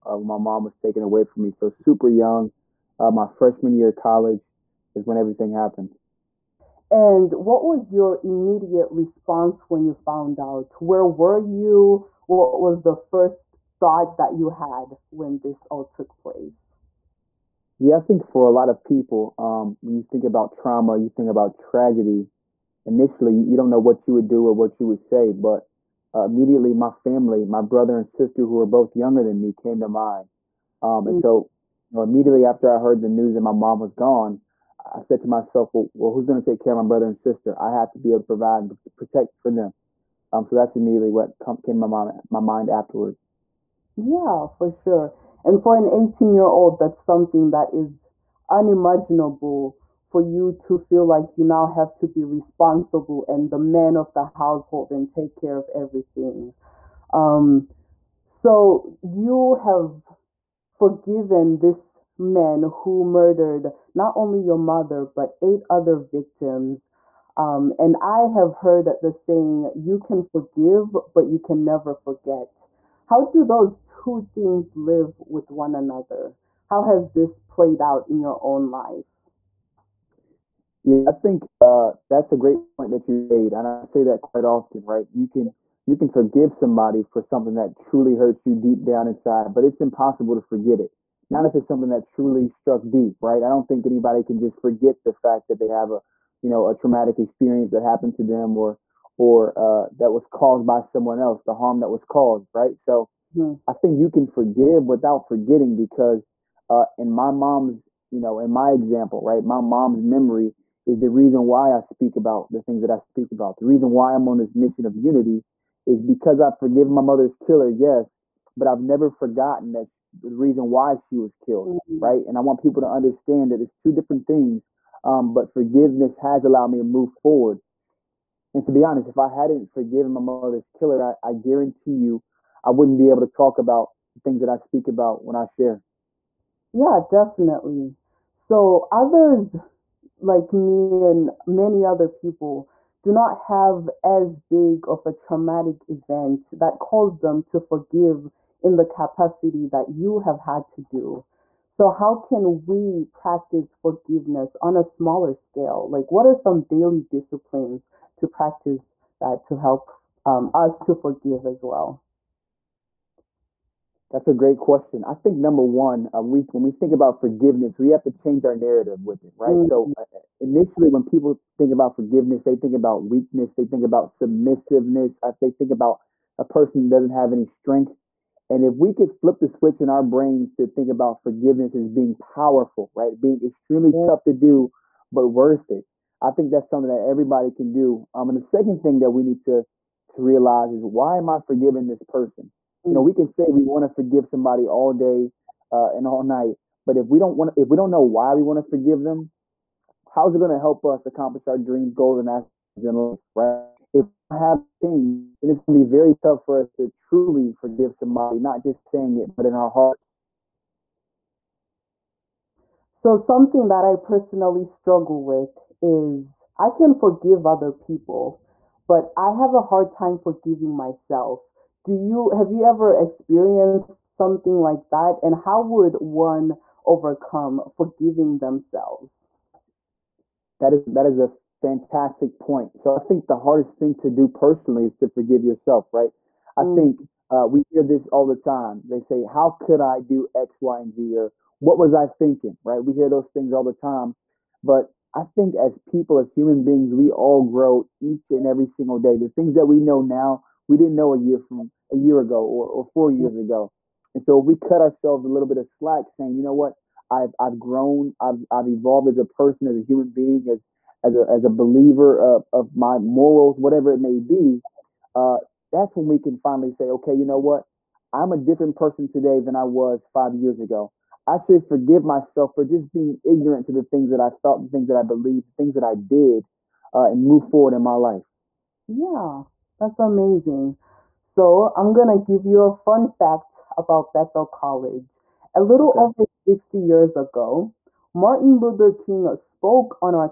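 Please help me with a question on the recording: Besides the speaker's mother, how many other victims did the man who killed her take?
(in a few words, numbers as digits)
8.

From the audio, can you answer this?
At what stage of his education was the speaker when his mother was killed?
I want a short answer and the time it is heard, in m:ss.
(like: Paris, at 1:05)
Freshman year of college, at 0:03.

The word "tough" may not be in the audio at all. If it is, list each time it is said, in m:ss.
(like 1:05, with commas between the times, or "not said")
3:04, 3:26.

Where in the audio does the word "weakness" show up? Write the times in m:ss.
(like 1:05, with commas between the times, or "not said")
2:53.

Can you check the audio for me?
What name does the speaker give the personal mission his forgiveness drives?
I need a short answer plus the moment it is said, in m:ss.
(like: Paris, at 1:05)
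Unity, at 1:54.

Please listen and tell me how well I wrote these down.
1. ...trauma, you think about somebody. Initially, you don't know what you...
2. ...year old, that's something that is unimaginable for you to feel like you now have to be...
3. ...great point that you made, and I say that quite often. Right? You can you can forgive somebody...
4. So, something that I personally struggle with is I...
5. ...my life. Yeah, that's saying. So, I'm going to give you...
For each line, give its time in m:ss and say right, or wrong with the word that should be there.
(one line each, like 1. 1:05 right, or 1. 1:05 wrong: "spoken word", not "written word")
1. 0:20 wrong: "tragedy", not "somebody"
2. 0:46 right
3. 1:22 right
4. 3:32 right
5. 4:37 wrong: "amazing", not "saying".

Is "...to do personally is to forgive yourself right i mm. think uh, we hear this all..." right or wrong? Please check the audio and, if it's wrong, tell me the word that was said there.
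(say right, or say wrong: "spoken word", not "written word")
right.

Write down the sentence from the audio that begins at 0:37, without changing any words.
I have to be able to provide and protect for them.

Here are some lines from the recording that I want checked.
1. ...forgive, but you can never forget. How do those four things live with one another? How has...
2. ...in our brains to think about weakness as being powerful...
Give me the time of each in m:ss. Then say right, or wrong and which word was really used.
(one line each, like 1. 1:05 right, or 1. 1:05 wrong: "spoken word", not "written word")
1. 1:10 wrong: "two", not "four"
2. 2:59 wrong: "forgiveness", not "weakness".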